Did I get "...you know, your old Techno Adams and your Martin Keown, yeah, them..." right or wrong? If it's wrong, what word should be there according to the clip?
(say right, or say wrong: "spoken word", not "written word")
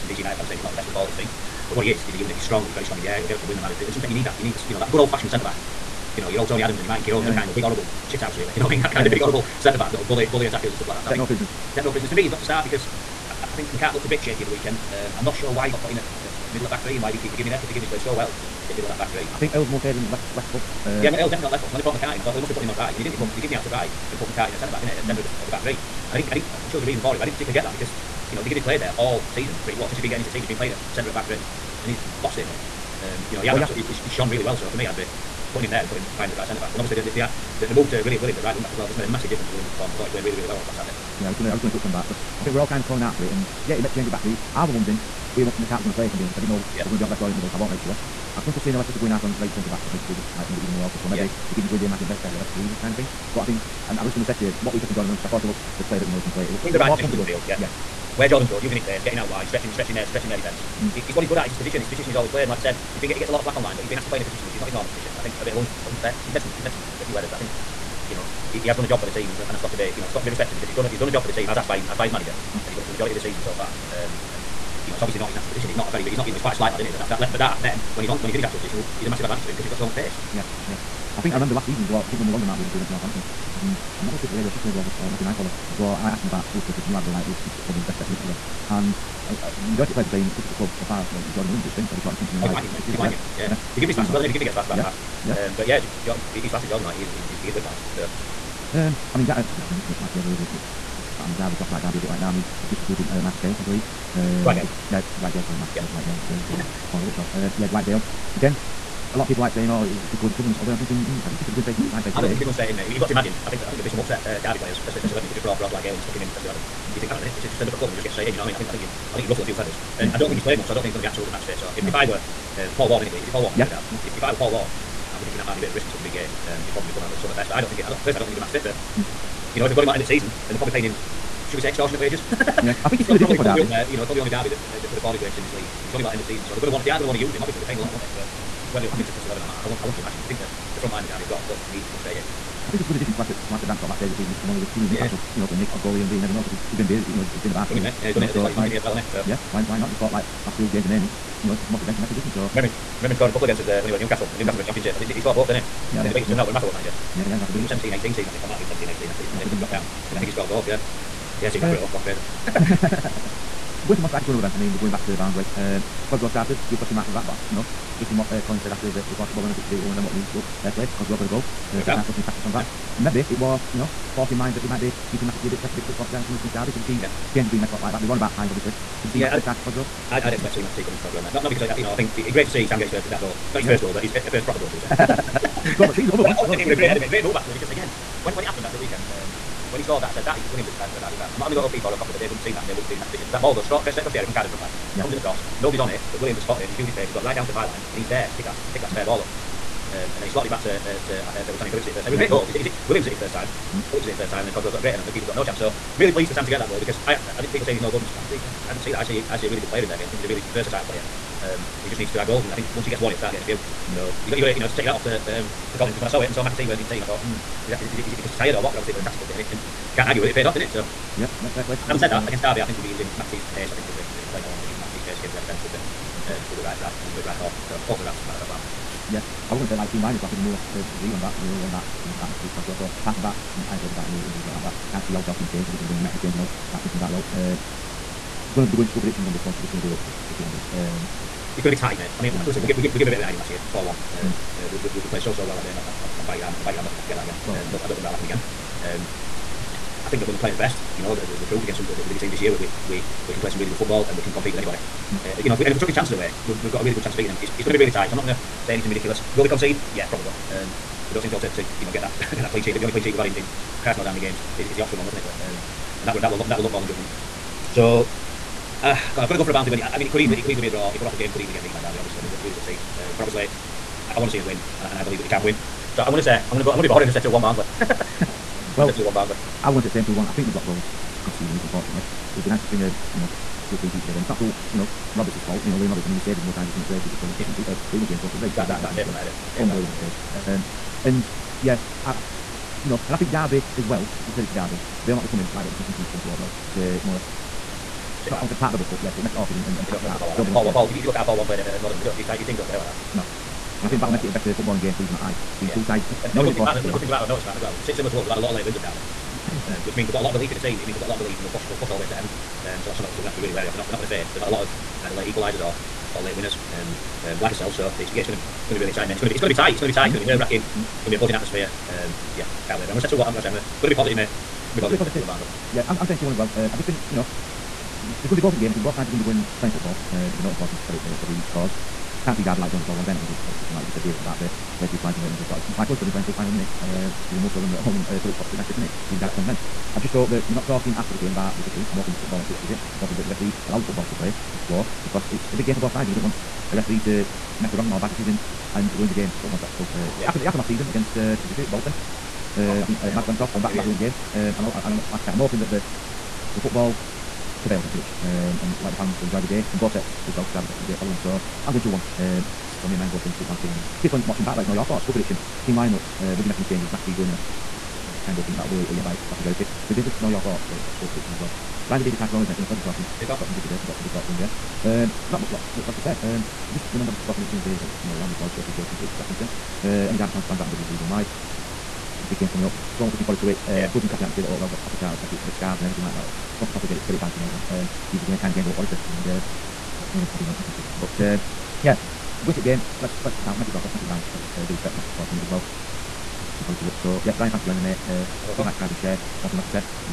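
wrong: "Tony", not "Techno".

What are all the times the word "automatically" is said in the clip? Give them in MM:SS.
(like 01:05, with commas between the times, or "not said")
not said.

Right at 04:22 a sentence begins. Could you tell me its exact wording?
I think the only clean sheet we've had in, in Christ knows how many games is is the Oxford one, wasn't it?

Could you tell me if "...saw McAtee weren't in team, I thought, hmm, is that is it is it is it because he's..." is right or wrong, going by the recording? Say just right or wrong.
right.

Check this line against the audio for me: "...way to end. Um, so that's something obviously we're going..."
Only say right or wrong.
right.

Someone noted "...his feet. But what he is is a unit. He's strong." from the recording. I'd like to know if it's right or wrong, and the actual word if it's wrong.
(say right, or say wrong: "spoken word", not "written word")
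right.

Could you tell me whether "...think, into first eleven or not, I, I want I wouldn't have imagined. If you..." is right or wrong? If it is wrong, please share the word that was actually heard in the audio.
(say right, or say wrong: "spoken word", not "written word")
right.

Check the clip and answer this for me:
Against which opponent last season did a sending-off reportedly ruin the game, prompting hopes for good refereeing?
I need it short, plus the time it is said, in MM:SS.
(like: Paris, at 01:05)
Bolton, at 05:51.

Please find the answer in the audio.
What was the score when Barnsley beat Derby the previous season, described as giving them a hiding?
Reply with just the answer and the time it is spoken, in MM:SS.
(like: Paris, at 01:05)
4-1, at 04:03.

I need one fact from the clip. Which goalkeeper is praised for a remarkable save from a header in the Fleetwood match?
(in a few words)
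Liam Roberts.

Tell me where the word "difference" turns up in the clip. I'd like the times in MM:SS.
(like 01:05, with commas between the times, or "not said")
00:39, 02:32.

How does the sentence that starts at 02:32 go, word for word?
So remember, remember him scoring a couple against us uh, when he were at Newcastle, at Newcastle, in at Championship.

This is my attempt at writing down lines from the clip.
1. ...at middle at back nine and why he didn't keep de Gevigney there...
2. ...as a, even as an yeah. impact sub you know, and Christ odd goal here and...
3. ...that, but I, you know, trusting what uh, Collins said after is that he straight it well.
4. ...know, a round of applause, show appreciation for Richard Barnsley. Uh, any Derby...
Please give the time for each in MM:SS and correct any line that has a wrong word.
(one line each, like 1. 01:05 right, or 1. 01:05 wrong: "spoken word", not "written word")
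1. 00:16 wrong: "three", not "nine"
2. 02:24 wrong: "Nick", not "Christ"
3. 02:47 wrong: "thought", not "straight"
4. 06:18 wrong: "Atkinson", not "Barnsley".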